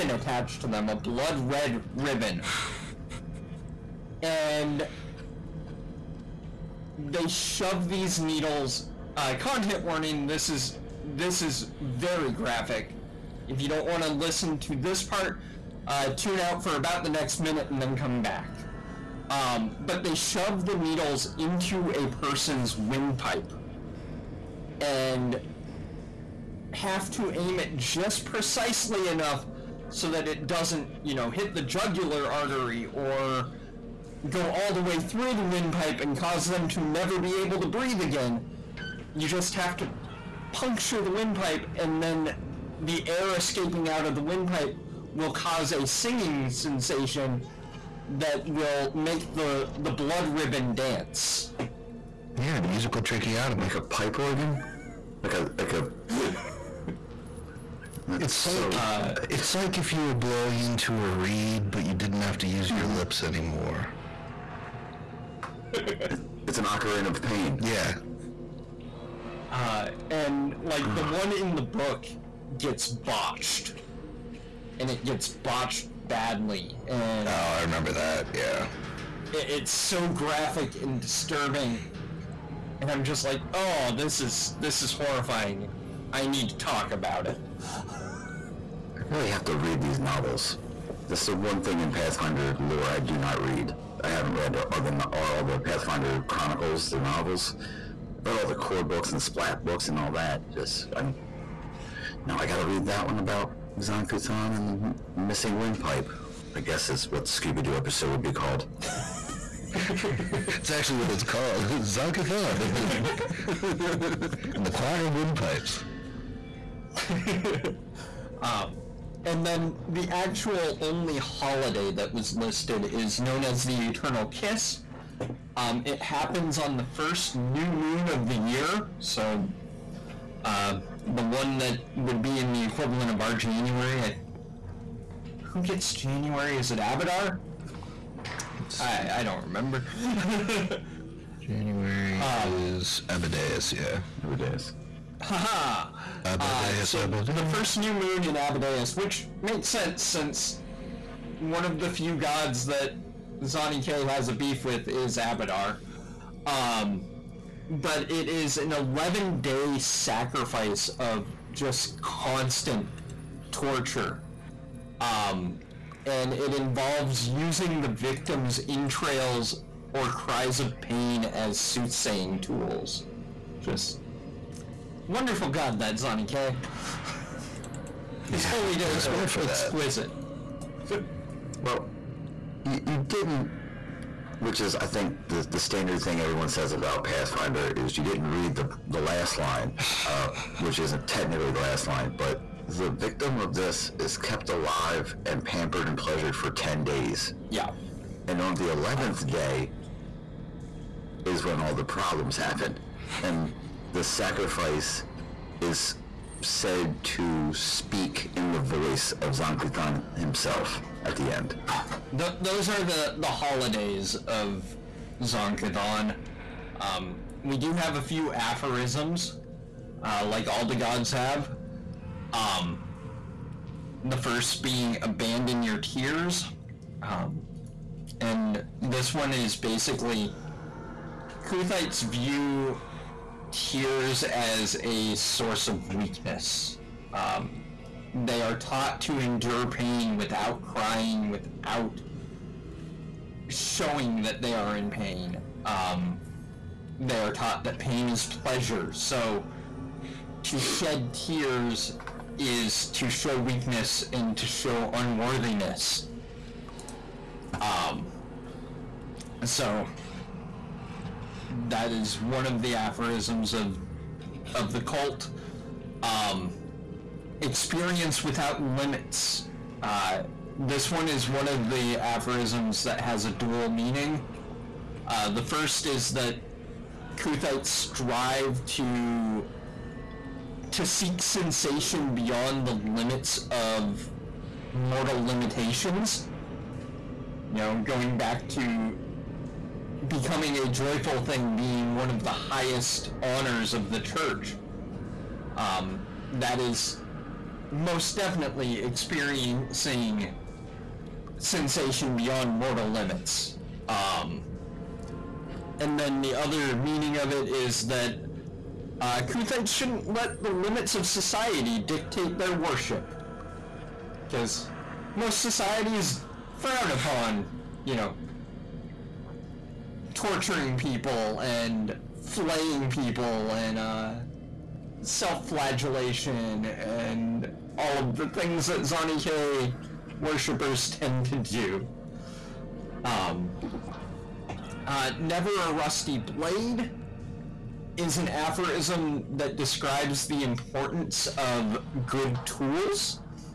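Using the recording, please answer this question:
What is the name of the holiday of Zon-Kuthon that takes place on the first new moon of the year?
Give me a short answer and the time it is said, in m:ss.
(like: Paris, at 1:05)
The Eternal Kiss, at 2:03.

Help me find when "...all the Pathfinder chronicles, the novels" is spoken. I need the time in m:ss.
1:35.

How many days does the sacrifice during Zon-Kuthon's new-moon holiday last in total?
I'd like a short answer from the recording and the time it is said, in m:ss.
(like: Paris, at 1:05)
11, at 2:38.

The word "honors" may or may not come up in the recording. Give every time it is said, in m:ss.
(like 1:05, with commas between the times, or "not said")
4:53.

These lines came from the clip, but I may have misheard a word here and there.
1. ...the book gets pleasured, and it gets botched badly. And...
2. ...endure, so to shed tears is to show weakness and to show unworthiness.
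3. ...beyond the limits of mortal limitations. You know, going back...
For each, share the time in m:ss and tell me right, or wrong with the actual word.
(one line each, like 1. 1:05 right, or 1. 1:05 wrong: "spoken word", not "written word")
1. 1:11 wrong: "botched", not "pleasured"
2. 4:08 wrong: "pleasure", not "endure"
3. 4:42 right.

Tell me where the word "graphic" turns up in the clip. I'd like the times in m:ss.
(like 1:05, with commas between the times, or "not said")
0:12, 1:20.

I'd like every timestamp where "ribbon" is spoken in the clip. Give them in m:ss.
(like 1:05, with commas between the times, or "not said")
0:01, 0:50.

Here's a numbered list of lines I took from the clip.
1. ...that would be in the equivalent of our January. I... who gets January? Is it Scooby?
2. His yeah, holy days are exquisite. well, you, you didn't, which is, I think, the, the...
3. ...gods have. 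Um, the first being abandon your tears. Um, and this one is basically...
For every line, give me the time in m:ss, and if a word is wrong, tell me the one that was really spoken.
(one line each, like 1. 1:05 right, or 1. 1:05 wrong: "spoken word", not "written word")
1. 2:11 wrong: "Avatar", not "Scooby"
2. 2:58 right
3. 3:40 right.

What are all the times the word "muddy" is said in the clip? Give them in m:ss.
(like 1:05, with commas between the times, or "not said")
not said.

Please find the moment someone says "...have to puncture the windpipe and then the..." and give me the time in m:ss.
0:39.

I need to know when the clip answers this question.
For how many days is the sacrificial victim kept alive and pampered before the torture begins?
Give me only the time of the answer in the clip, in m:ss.
3:16.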